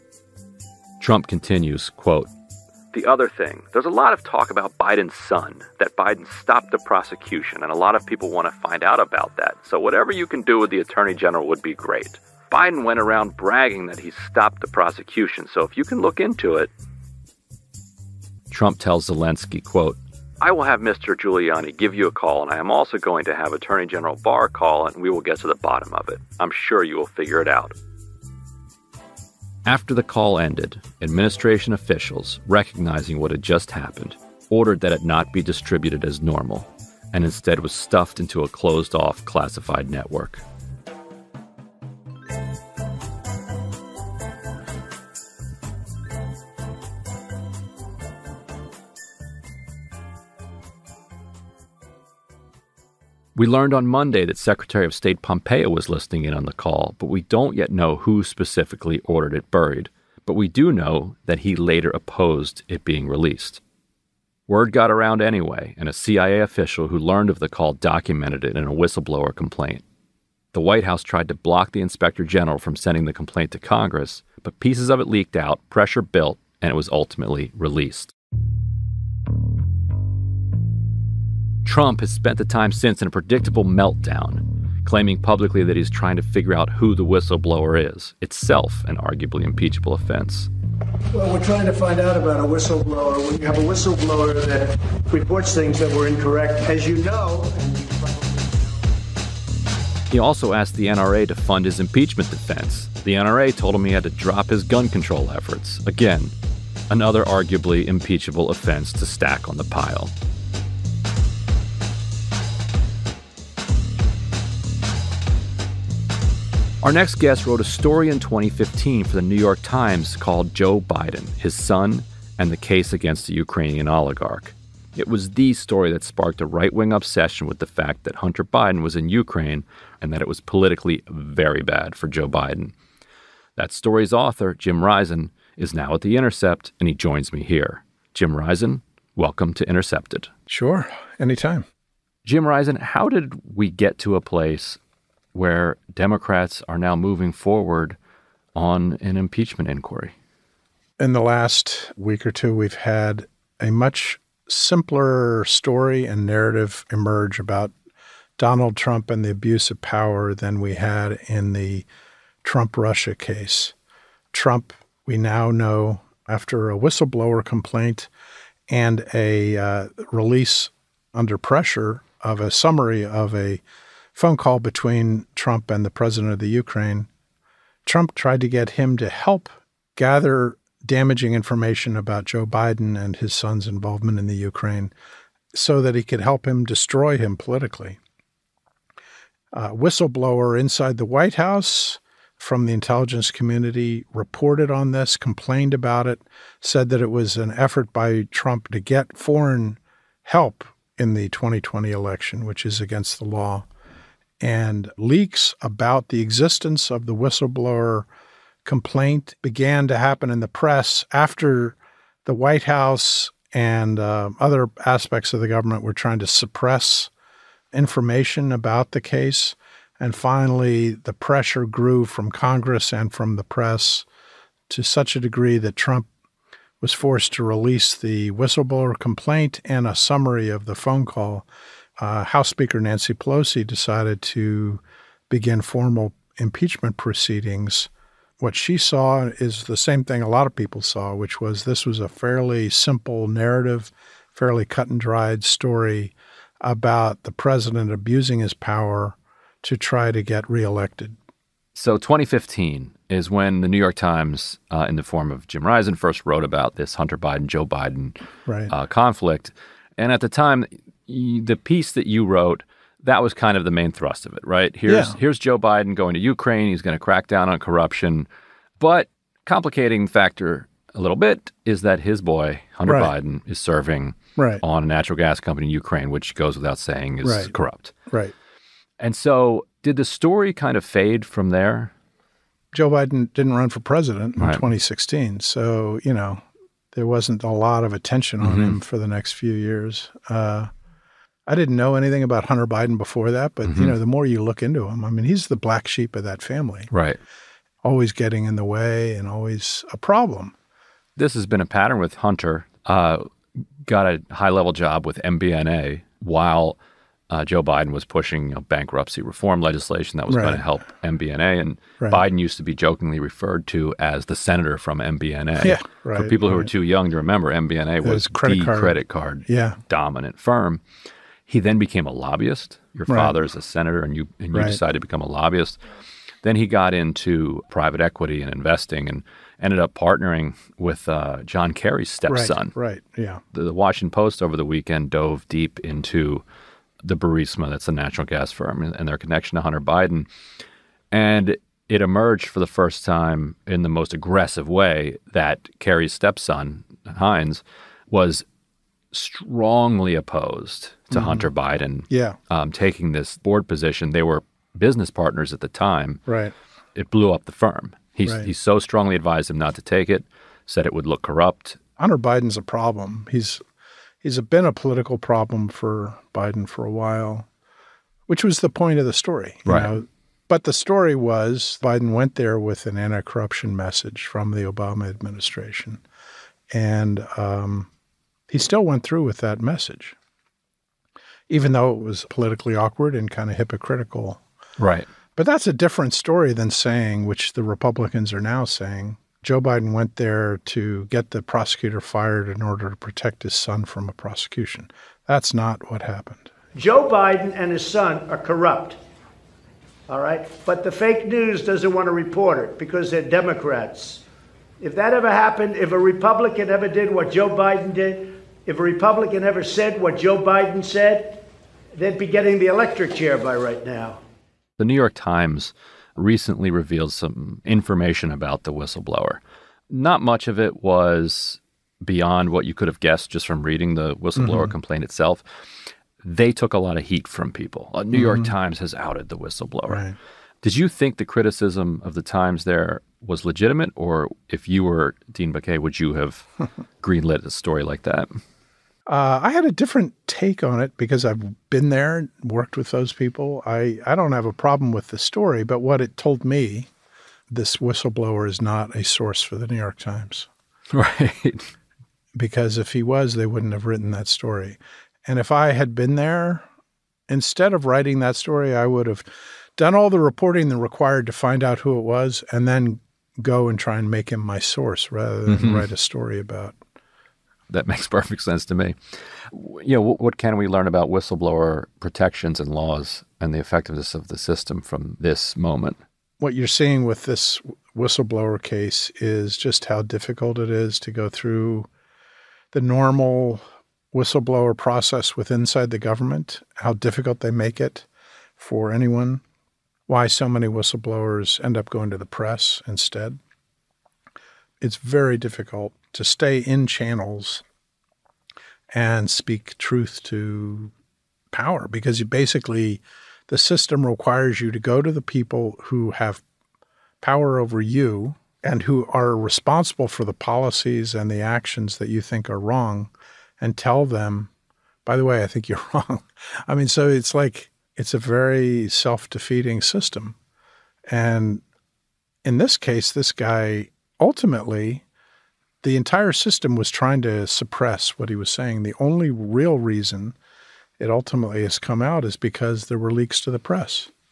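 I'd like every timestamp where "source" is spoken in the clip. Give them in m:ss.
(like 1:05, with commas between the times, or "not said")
7:29, 7:44.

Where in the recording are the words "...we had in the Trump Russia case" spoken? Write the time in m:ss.
2:40.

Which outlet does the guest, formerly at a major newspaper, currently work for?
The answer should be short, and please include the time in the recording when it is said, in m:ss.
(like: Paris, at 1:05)
The Intercept, at 2:16.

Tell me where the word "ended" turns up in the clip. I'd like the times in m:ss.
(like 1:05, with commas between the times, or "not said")
0:30, 5:29.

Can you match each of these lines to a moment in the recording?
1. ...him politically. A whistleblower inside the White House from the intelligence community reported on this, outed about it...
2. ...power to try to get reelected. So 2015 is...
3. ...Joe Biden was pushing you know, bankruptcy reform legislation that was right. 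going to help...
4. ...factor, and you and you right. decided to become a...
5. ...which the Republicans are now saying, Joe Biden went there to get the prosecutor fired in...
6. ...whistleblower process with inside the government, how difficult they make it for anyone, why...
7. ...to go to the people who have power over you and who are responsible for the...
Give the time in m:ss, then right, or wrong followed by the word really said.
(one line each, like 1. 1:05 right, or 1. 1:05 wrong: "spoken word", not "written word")
1. 3:07 wrong: "complained", not "outed"
2. 4:08 right
3. 5:07 right
4. 5:23 wrong: "senator", not "factor"
5. 6:27 right
6. 8:04 right
7. 8:24 right.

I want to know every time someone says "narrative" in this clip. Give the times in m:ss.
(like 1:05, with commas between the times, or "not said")
2:36, 4:03.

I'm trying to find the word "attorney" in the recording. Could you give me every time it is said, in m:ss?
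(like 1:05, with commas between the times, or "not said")
0:10, 0:23.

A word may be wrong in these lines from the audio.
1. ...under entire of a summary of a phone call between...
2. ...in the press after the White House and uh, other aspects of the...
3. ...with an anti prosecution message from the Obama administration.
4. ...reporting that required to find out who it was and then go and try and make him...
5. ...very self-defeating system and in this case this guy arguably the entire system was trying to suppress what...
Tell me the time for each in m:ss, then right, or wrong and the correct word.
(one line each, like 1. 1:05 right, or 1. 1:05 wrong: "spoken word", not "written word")
1. 2:51 wrong: "pressure", not "entire"
2. 3:30 right
3. 6:12 wrong: "corruption", not "prosecution"
4. 7:40 right
5. 8:38 wrong: "ultimately", not "arguably".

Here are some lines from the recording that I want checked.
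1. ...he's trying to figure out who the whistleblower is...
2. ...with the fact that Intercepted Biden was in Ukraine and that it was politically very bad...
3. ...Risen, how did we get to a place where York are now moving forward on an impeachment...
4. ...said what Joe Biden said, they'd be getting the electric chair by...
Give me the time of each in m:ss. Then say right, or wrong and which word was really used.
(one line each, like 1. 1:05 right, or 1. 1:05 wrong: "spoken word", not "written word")
1. 1:25 right
2. 2:07 wrong: "Hunter", not "Intercepted"
3. 2:22 wrong: "Democrats", not "York"
4. 6:49 right.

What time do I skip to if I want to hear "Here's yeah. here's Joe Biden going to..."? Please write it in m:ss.
4:24.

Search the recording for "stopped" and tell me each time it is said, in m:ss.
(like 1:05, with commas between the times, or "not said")
0:06, 0:14.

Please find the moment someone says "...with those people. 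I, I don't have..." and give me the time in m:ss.
7:22.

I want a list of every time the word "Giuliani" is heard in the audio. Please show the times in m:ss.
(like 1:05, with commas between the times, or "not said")
0:21.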